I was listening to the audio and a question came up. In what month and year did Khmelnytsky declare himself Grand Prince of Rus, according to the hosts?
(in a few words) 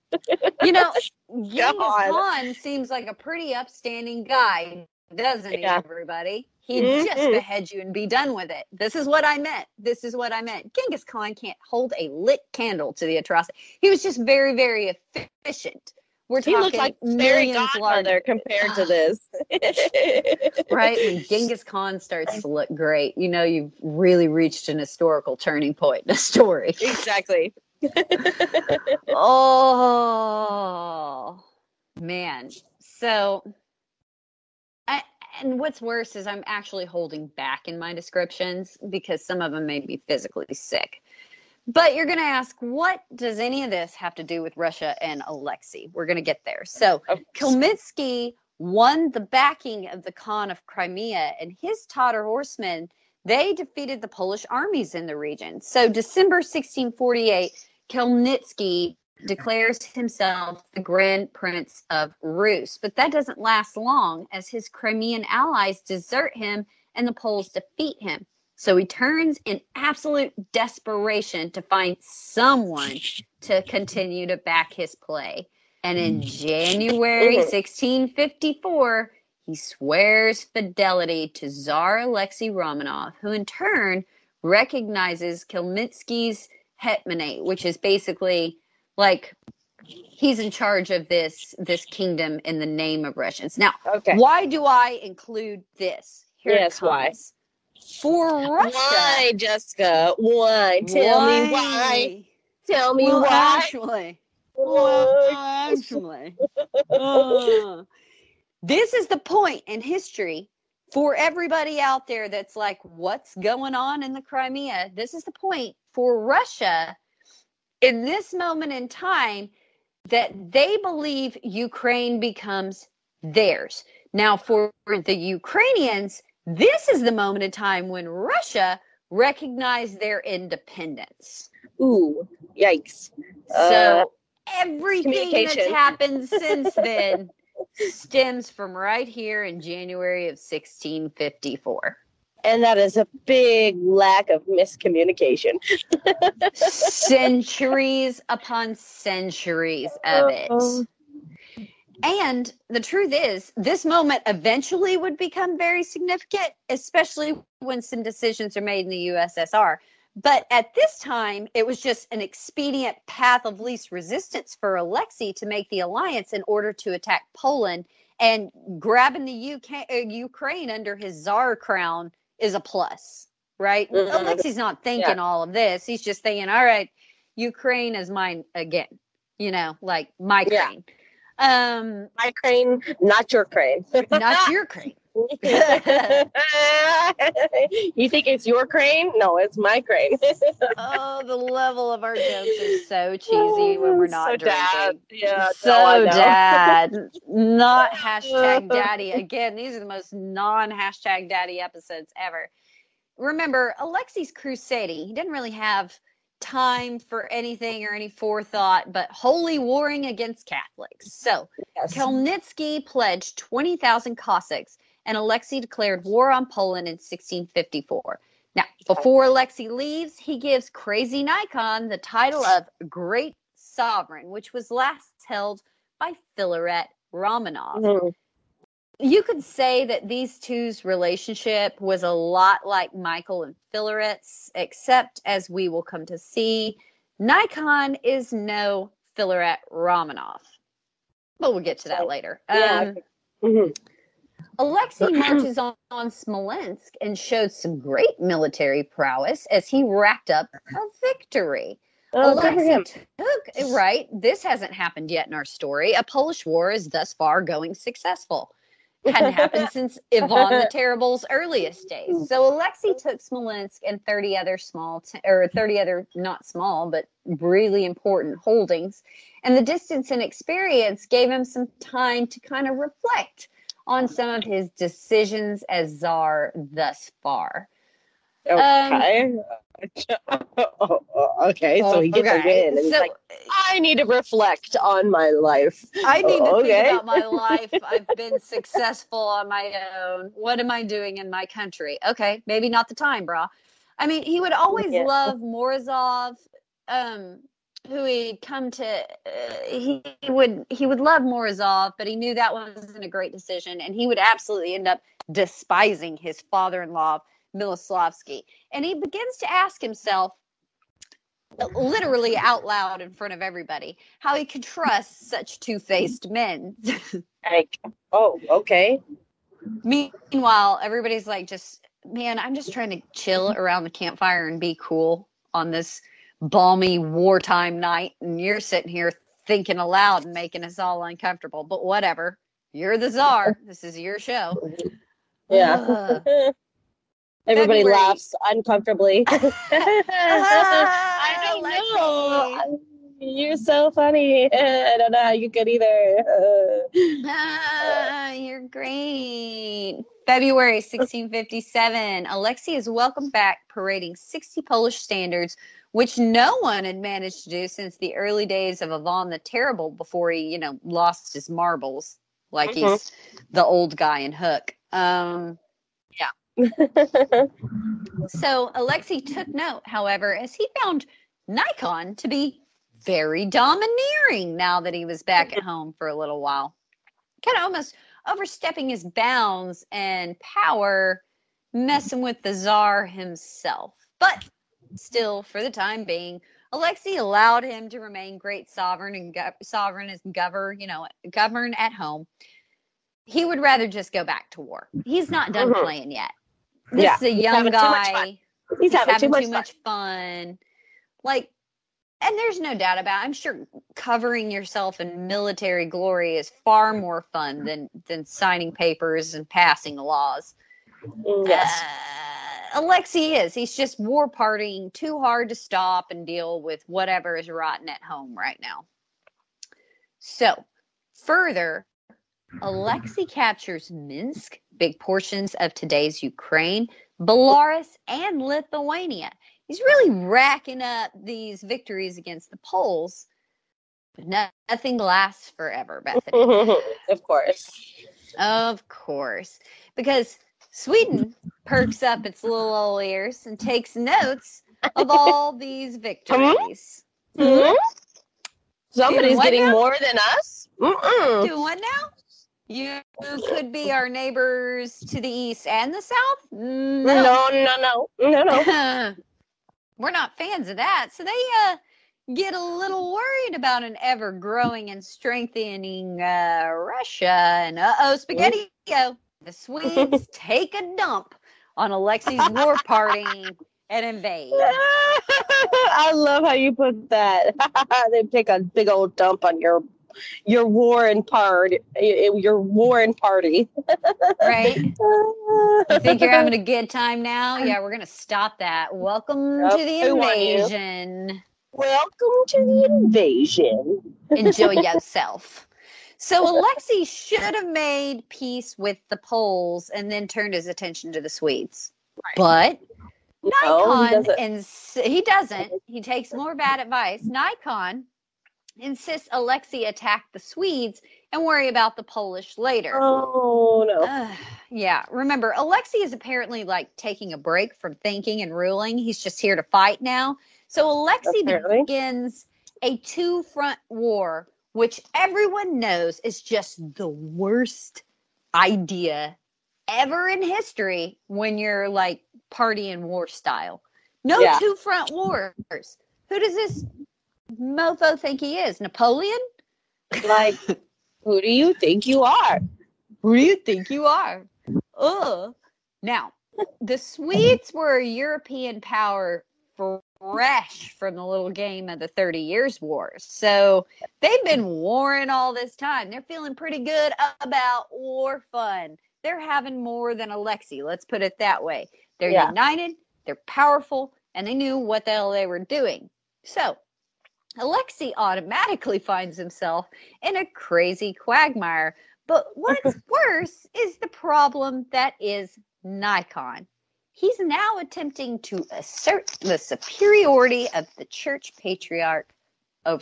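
December 1648.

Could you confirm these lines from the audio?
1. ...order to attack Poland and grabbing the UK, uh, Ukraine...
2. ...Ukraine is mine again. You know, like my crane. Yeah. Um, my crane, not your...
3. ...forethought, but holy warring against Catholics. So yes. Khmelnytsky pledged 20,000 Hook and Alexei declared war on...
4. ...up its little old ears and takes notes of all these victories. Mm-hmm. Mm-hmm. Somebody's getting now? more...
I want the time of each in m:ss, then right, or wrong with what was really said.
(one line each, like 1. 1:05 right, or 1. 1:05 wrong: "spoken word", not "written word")
1. 2:46 right
2. 2:57 right
3. 3:28 wrong: "Cossacks", not "Hook"
4. 7:22 right.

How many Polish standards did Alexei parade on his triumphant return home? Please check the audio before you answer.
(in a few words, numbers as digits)
60.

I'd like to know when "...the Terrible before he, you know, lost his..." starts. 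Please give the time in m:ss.
5:59.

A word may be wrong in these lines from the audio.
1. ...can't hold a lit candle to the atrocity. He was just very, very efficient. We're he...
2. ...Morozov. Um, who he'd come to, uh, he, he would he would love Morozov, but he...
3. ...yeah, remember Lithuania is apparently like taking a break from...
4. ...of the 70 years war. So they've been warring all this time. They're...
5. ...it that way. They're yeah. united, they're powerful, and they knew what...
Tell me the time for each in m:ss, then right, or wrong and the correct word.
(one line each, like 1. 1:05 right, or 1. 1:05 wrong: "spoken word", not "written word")
1. 0:11 right
2. 4:55 right
3. 8:34 wrong: "Alexei", not "Lithuania"
4. 9:11 wrong: "30", not "70"
5. 9:21 right.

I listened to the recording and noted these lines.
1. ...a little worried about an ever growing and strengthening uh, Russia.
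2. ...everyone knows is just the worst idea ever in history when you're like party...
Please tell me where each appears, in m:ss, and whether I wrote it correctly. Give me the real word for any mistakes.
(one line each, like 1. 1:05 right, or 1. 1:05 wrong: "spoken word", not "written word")
1. 7:42 right
2. 8:45 right.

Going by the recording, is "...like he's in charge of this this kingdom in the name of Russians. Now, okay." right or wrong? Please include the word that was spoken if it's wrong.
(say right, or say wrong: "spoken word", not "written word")
right.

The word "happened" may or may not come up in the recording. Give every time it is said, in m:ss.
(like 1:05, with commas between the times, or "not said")
2:15, 4:14, 4:19.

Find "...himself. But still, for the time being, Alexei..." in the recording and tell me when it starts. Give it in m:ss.
6:23.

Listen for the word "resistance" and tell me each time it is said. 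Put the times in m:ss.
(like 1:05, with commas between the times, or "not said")
2:43.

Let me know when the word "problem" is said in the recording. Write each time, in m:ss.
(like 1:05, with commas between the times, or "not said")
9:34.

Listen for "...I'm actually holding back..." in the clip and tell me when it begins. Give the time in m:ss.
0:36.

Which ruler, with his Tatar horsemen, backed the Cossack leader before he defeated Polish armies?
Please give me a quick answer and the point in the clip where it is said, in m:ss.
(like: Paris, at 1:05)
Khan of Crimea, at 0:50.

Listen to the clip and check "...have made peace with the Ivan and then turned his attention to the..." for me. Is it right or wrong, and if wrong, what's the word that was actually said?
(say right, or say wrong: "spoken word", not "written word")
wrong: "Poles", not "Ivan".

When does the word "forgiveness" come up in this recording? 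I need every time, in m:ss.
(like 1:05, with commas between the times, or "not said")
not said.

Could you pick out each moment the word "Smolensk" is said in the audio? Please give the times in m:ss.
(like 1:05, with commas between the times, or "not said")
4:06, 4:23.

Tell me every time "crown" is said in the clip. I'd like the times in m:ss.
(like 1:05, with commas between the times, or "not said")
2:51.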